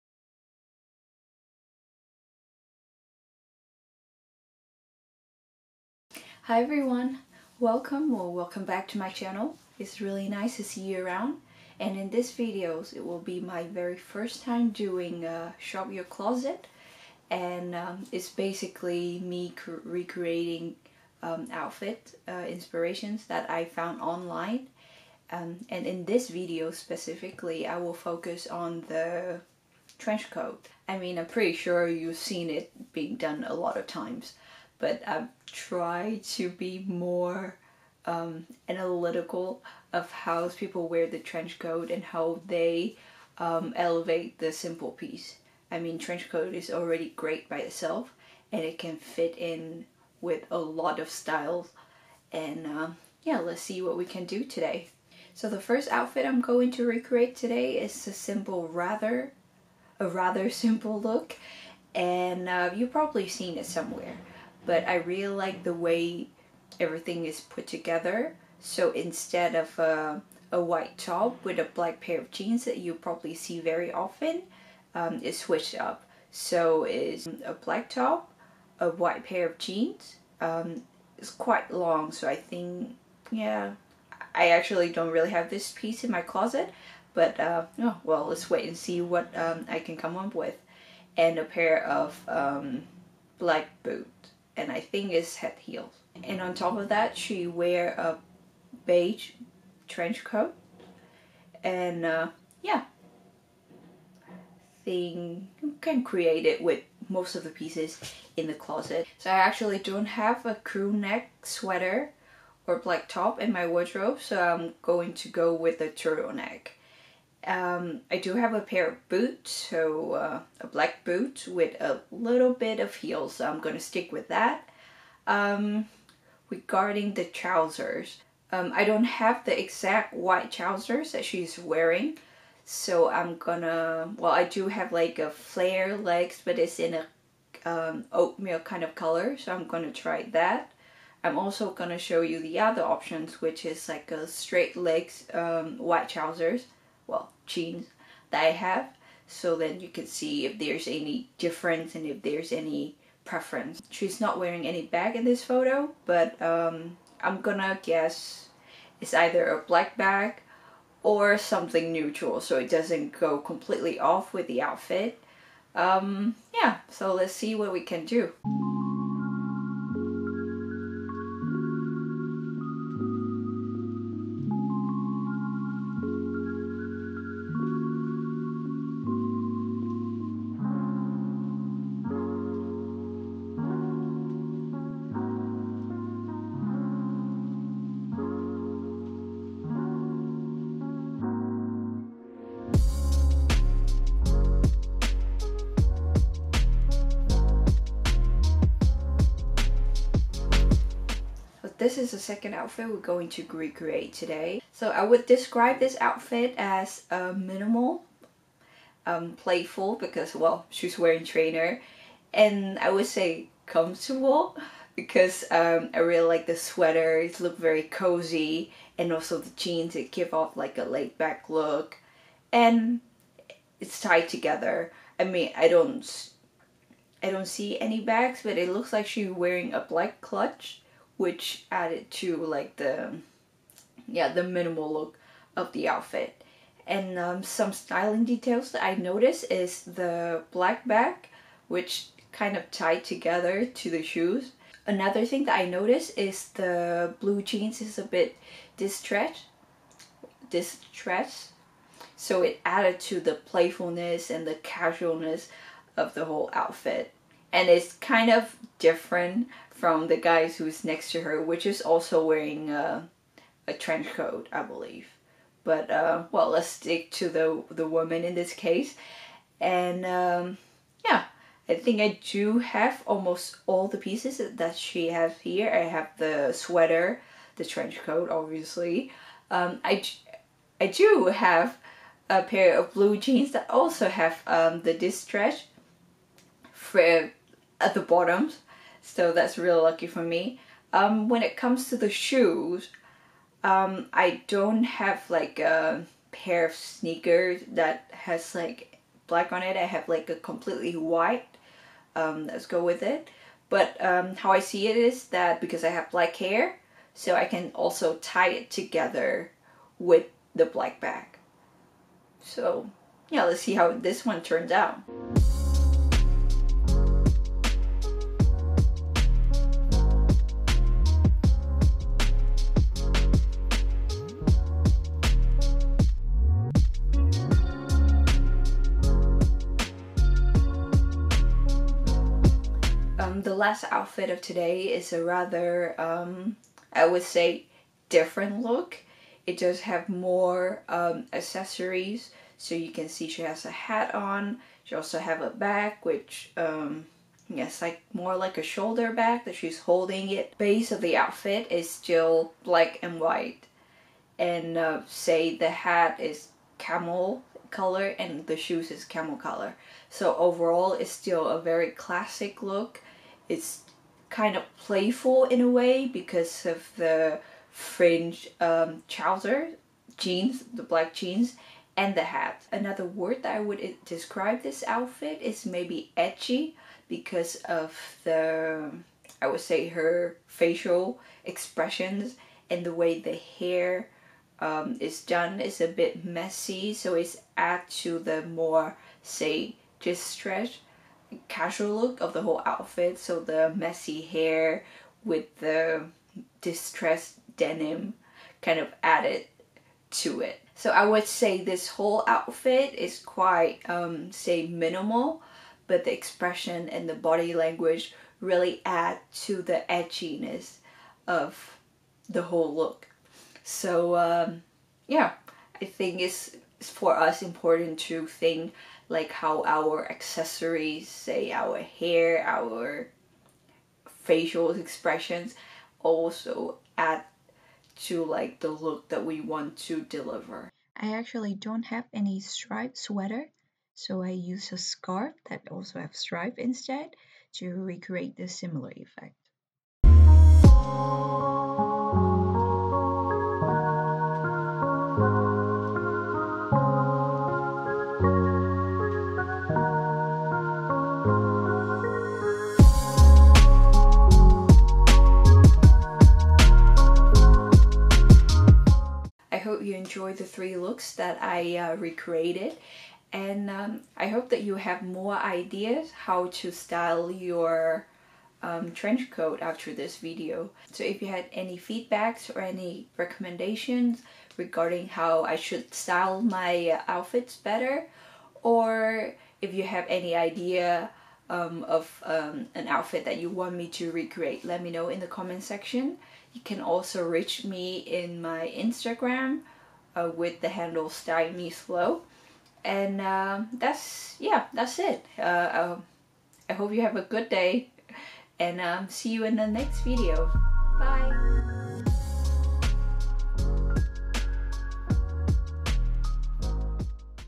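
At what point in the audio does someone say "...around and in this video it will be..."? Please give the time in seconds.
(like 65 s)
11 s.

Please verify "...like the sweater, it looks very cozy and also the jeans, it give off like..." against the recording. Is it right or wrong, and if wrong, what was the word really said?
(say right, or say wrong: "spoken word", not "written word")
right.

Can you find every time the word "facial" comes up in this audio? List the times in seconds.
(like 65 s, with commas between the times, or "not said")
380 s, 424 s.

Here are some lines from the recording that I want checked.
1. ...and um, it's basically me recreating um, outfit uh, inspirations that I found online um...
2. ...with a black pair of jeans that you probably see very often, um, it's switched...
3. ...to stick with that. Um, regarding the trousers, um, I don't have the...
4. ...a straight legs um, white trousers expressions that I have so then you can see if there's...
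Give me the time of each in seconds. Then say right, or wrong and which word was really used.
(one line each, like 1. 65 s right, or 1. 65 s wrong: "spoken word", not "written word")
1. 17 s right
2. 71 s right
3. 123 s right
4. 144 s wrong: "jeans", not "expressions".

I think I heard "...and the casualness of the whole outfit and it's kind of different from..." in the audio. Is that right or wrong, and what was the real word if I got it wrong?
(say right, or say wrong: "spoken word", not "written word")
right.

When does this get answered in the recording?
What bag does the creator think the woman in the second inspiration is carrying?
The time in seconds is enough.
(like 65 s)
229 s.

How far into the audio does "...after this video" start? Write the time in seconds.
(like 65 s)
469 s.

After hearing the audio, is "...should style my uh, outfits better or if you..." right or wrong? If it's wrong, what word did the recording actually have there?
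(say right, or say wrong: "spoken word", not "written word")
right.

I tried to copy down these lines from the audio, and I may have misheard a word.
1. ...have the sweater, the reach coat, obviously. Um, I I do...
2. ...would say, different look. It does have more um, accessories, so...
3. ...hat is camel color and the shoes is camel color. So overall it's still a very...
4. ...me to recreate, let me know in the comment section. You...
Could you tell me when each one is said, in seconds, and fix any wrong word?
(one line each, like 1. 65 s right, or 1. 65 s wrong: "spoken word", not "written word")
1. 275 s wrong: "trench", not "reach"
2. 337 s right
3. 355 s right
4. 483 s right.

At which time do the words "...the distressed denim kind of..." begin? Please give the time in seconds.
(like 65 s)
395 s.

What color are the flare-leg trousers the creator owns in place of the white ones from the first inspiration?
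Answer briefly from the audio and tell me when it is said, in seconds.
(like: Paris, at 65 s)
Oatmeal, at 138 s.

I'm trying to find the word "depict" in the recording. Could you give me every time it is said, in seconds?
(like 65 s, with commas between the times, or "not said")
not said.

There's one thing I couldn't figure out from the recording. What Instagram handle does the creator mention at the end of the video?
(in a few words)
Style Me Slow.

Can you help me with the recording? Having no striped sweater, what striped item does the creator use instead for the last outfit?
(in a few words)
A scarf.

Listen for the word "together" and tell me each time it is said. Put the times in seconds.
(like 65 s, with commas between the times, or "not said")
67 s, 224 s, 243 s, 308 s.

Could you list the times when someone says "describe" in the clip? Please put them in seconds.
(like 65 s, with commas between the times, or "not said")
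205 s, 374 s.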